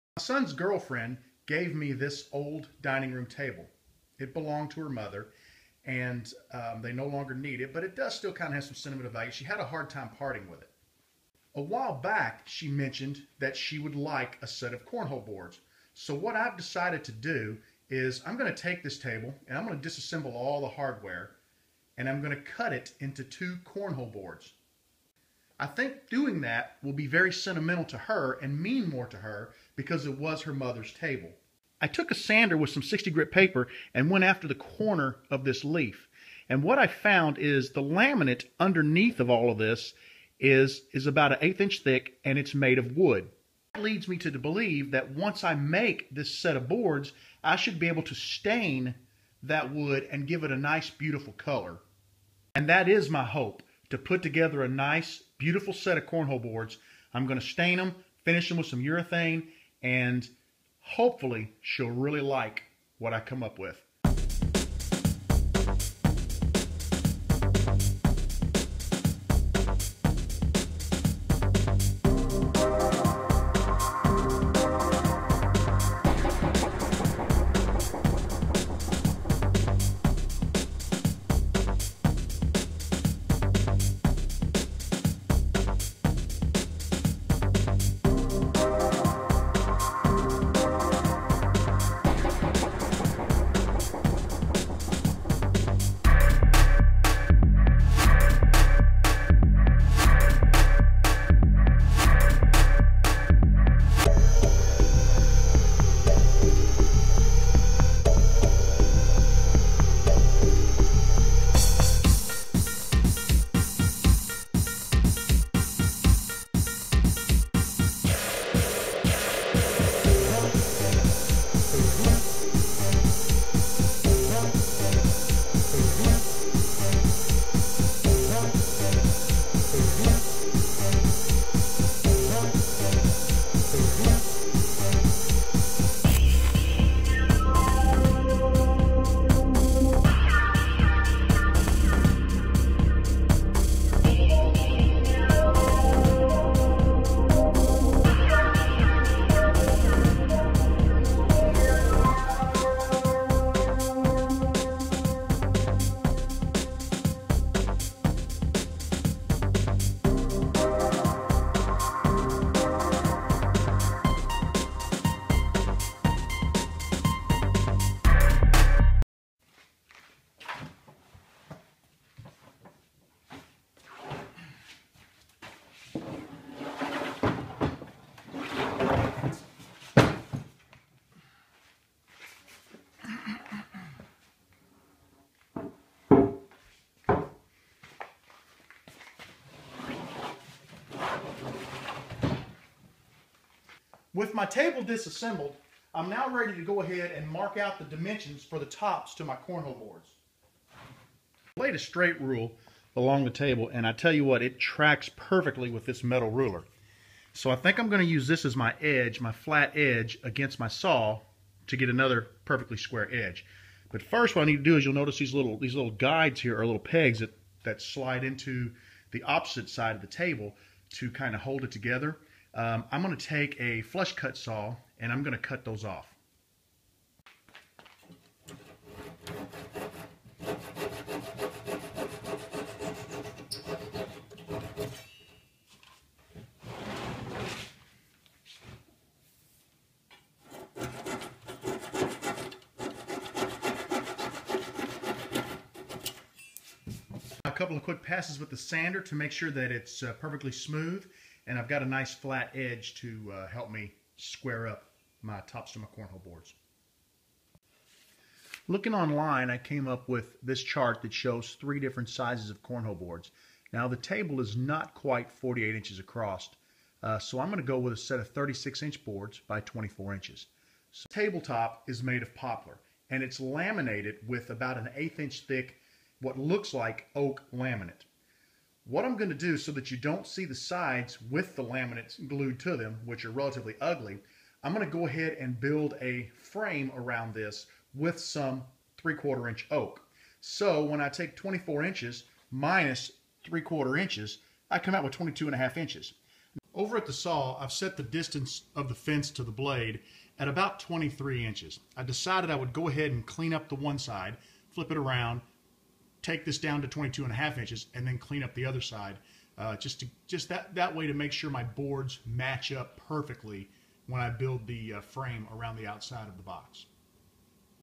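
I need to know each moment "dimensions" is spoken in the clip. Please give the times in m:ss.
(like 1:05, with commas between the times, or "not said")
3:17.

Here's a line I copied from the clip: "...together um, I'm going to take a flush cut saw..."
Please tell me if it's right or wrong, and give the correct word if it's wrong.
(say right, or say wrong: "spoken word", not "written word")
right.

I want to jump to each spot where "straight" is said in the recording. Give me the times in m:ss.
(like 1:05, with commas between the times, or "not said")
3:21.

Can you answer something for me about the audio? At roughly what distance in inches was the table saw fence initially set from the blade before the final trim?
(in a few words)
23.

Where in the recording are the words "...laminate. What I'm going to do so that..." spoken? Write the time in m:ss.
4:37.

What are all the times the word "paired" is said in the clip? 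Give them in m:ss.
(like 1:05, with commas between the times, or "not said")
not said.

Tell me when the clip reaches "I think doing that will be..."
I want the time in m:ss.
0:25.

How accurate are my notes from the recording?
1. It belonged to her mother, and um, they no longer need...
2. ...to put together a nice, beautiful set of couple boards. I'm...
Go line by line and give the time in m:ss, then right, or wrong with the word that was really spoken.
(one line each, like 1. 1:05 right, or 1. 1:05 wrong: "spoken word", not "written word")
1. 0:04 right
2. 0:53 wrong: "cornhole", not "couple".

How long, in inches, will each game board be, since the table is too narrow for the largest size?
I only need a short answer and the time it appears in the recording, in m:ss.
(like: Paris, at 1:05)
36, at 4:28.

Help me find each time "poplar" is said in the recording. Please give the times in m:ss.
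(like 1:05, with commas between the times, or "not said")
4:32.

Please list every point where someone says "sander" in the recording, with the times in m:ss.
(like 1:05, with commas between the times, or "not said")
0:32, 4:08.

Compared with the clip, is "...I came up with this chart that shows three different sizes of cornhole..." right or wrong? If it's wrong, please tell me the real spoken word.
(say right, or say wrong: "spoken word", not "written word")
right.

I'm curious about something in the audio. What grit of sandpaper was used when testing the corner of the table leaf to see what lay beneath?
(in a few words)
60.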